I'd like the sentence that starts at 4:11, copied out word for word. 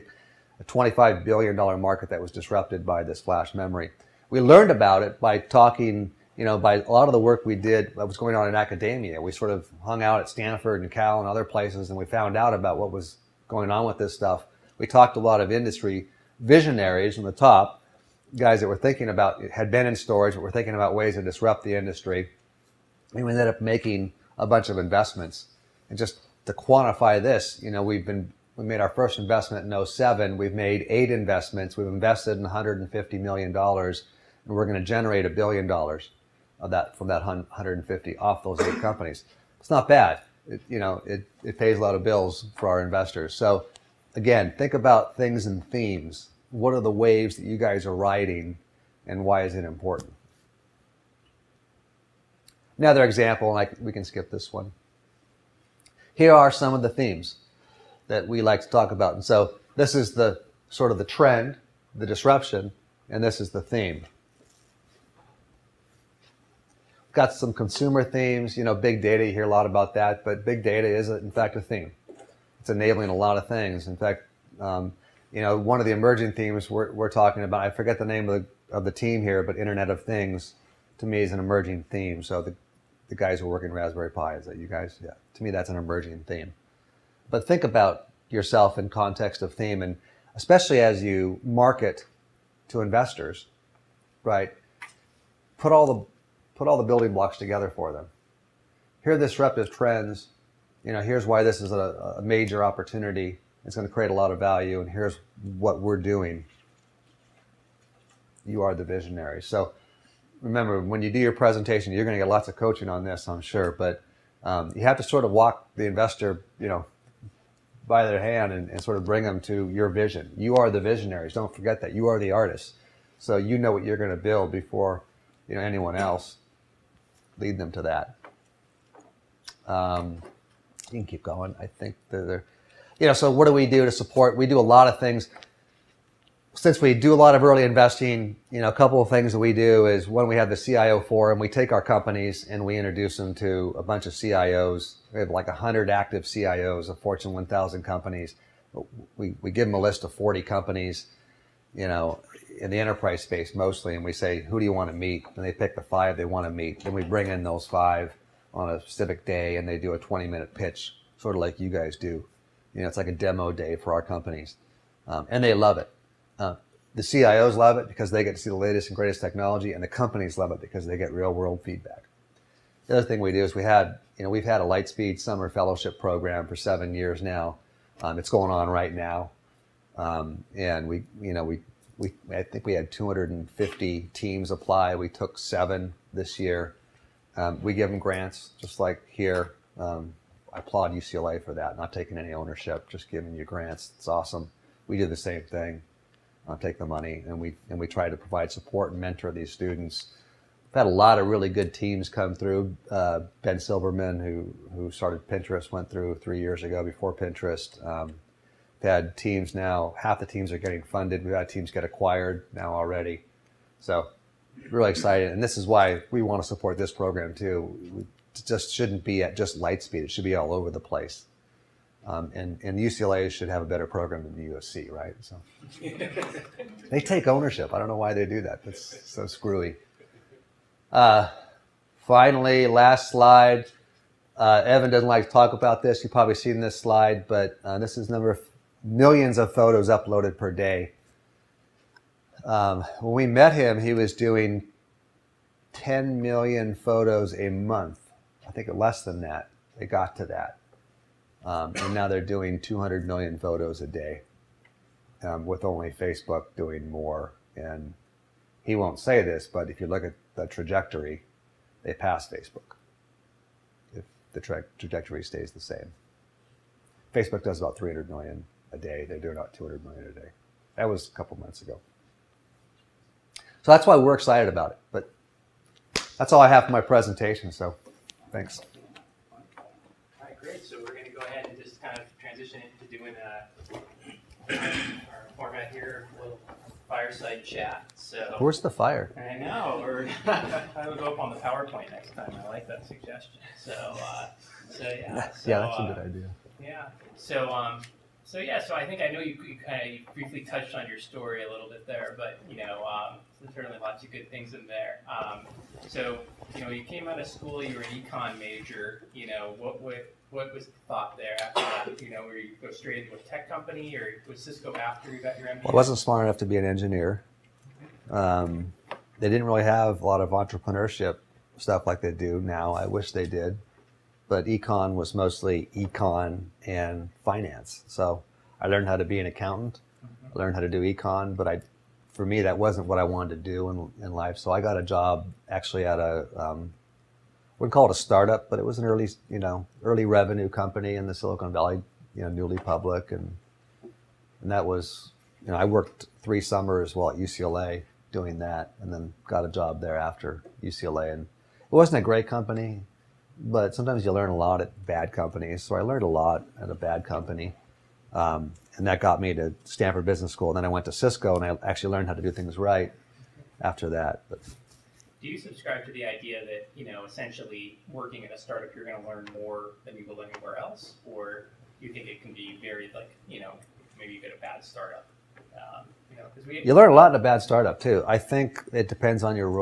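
Um, and now they're doing 200 million photos a day, um, with only Facebook doing more.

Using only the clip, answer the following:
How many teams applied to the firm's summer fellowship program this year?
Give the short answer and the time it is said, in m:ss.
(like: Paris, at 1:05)
250, at 3:02.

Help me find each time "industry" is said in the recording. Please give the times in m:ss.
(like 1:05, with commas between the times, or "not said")
0:15, 0:21.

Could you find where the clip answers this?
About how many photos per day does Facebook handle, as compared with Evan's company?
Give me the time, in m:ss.
4:27.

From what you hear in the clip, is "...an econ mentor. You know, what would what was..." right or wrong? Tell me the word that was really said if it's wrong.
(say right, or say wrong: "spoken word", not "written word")
wrong: "major", not "mentor".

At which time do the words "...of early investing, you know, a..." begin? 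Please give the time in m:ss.
2:17.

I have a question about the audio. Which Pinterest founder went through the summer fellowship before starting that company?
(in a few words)
Ben Silbermann.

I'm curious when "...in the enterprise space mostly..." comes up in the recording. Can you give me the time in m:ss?
2:32.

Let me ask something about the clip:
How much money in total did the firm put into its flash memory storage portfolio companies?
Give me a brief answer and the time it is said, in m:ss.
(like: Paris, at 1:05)
$150 million, at 0:32.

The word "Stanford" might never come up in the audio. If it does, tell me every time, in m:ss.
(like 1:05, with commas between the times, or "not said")
0:10, 5:59.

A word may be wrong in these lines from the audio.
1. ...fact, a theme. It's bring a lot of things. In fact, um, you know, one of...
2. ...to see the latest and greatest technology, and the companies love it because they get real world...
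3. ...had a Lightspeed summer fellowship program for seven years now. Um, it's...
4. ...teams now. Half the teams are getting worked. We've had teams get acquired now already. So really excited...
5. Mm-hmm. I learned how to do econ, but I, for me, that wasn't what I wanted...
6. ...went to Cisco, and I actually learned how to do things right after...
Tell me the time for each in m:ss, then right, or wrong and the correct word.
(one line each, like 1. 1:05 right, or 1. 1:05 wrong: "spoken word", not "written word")
1. 1:11 wrong: "enabling", not "bring"
2. 2:48 right
3. 2:54 right
4. 3:29 wrong: "funded", not "worked"
5. 5:30 right
6. 6:00 right.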